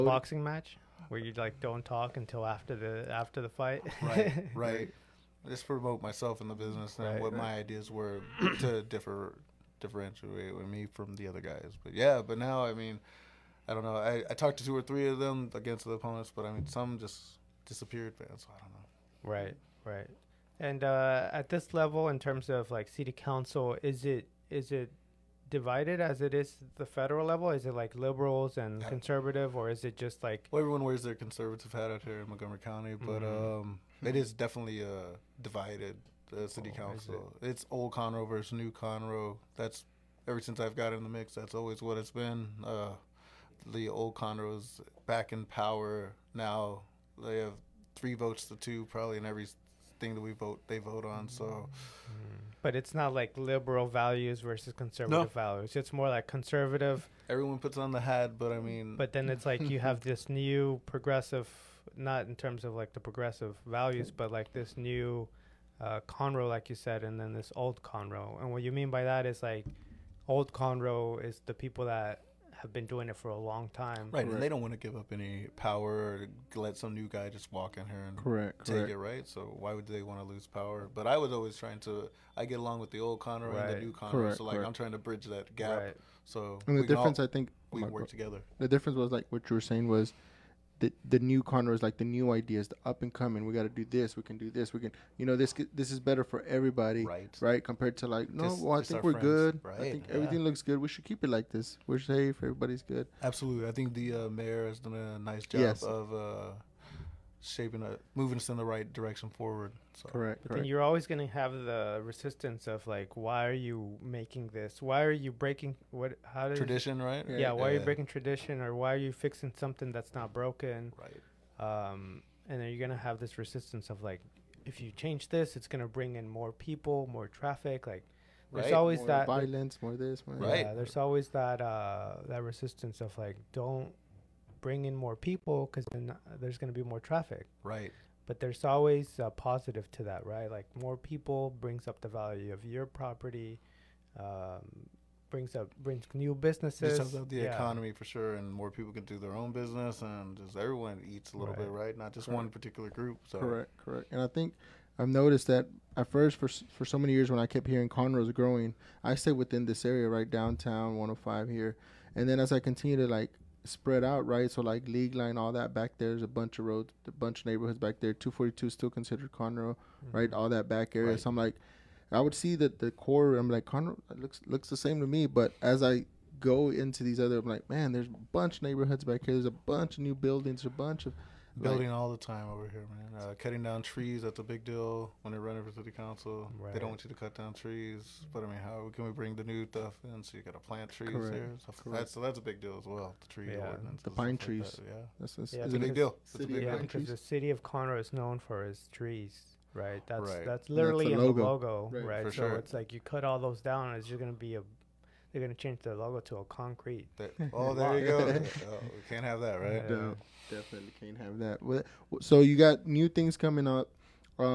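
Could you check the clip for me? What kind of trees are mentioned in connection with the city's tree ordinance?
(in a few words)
Pine trees.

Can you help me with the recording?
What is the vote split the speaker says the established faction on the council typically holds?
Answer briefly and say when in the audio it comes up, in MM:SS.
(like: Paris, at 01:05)
3 to 2, at 00:47.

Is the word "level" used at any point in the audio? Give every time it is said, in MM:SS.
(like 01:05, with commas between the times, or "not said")
00:21, 00:27.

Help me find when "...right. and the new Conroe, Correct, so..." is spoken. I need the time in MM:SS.
01:23.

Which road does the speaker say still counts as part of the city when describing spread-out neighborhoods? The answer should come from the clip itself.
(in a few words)
242.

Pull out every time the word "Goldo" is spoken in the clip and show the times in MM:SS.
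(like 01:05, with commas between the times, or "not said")
not said.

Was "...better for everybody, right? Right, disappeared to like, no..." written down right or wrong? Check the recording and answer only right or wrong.
wrong.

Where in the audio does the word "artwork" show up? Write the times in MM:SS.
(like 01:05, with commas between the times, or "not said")
not said.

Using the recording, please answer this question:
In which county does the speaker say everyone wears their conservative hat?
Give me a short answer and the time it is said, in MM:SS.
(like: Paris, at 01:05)
Montgomery County, at 00:32.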